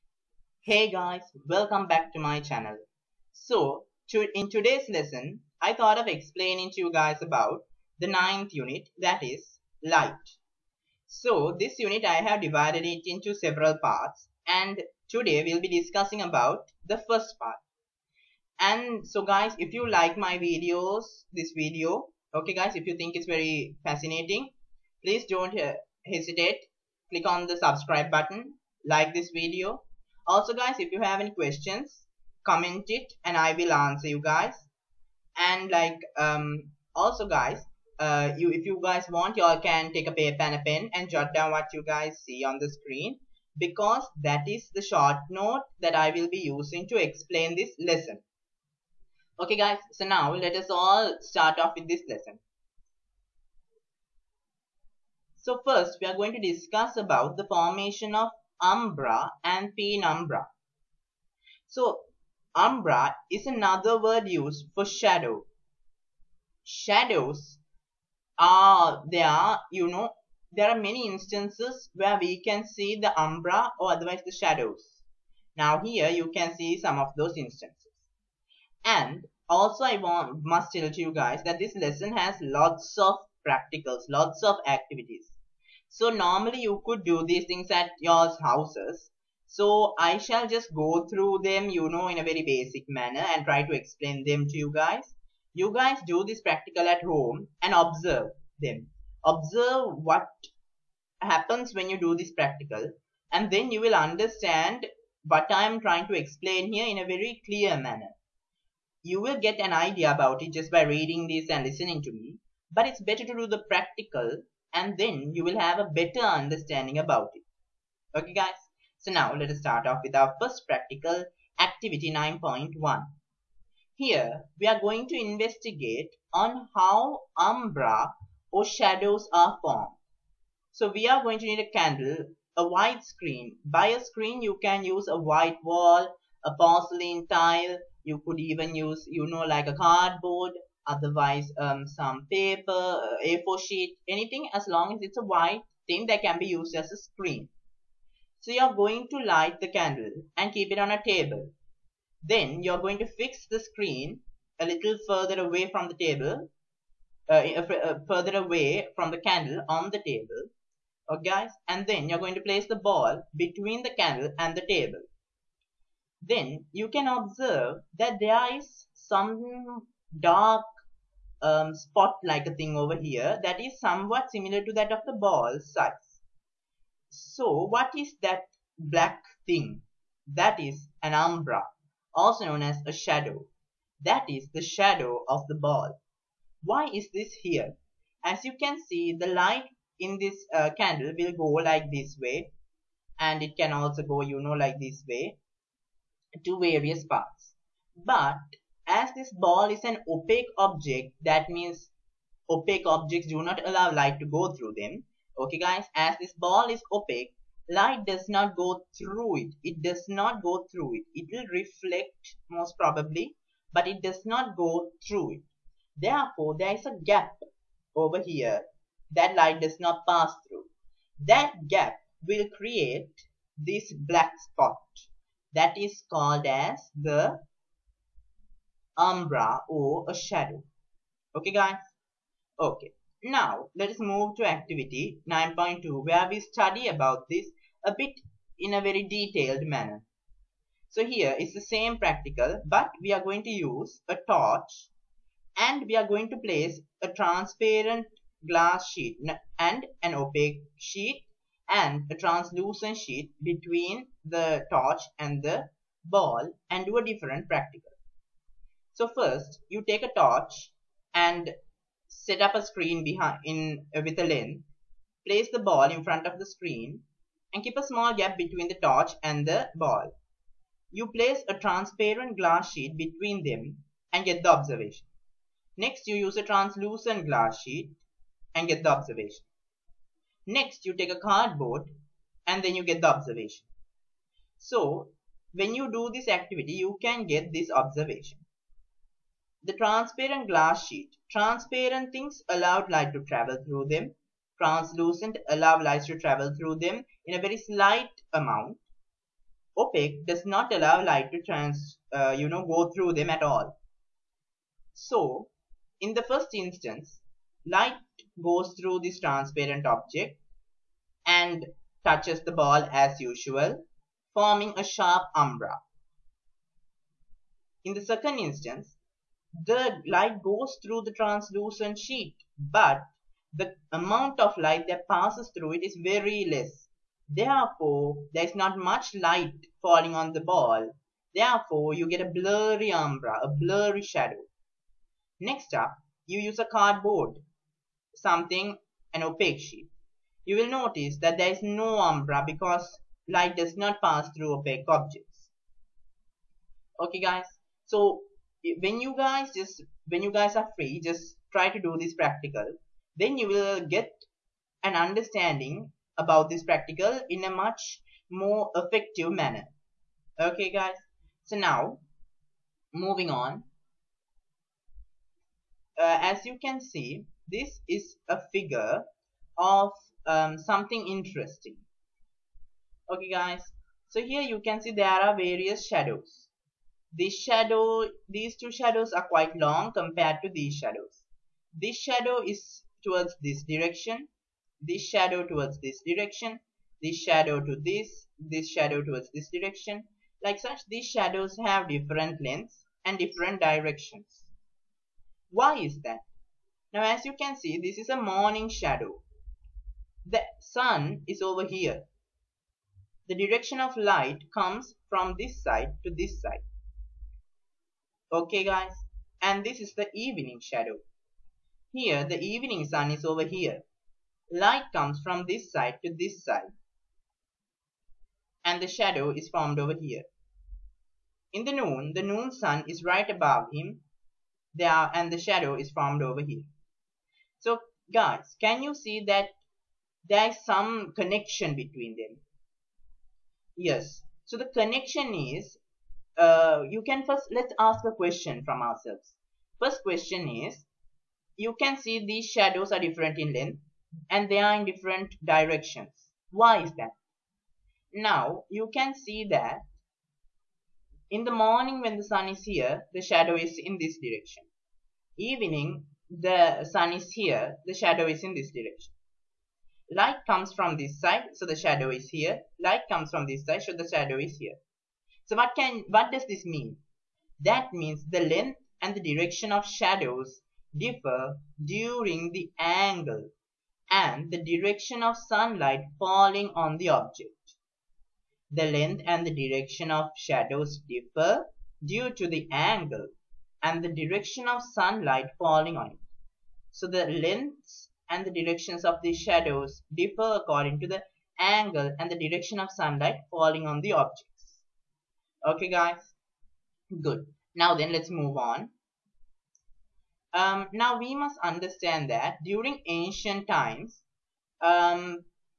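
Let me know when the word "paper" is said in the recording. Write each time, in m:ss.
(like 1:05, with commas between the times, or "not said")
0:40, 2:22.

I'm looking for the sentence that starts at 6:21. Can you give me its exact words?
This shadow is towards this direction, this shadow towards this direction, this shadow to this, this shadow towards this direction.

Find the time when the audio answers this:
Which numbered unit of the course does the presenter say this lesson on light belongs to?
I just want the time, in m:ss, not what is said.
0:08.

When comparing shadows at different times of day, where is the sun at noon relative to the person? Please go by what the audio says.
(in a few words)
right above him.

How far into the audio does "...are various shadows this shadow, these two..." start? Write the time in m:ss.
6:15.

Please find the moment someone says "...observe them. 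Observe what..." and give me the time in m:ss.
1:37.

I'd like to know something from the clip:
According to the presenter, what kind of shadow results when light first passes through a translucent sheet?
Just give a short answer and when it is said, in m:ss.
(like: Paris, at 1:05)
blurry umbra, at 5:32.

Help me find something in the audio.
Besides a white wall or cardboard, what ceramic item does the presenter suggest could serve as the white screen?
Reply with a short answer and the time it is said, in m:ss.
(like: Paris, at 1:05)
porcelain tile, at 2:16.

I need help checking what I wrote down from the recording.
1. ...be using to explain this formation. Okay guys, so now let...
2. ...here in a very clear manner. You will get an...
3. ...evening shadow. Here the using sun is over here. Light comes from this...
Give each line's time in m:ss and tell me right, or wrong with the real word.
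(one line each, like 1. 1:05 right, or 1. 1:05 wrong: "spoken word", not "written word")
1. 0:46 wrong: "lesson", not "formation"
2. 1:46 right
3. 6:50 wrong: "evening", not "using".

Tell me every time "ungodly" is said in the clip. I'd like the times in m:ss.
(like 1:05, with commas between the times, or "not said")
not said.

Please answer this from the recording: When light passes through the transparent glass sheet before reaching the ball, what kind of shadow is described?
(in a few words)
sharp umbra.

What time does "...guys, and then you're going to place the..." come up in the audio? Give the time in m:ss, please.
2:41.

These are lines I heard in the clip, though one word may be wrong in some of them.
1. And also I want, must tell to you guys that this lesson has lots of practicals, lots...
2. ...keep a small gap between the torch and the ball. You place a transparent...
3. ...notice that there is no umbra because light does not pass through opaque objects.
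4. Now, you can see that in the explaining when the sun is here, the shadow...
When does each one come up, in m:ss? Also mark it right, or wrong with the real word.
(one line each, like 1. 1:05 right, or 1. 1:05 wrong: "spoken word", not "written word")
1. 1:18 right
2. 4:27 right
3. 5:40 right
4. 7:28 wrong: "morning", not "explaining".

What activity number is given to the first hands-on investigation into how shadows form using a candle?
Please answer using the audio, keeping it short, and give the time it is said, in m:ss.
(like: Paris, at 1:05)
9.1, at 2:02.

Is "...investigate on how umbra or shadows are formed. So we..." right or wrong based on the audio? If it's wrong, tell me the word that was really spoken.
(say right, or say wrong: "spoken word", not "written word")
right.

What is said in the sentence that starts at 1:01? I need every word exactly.
So, umbra is another word used for shadow.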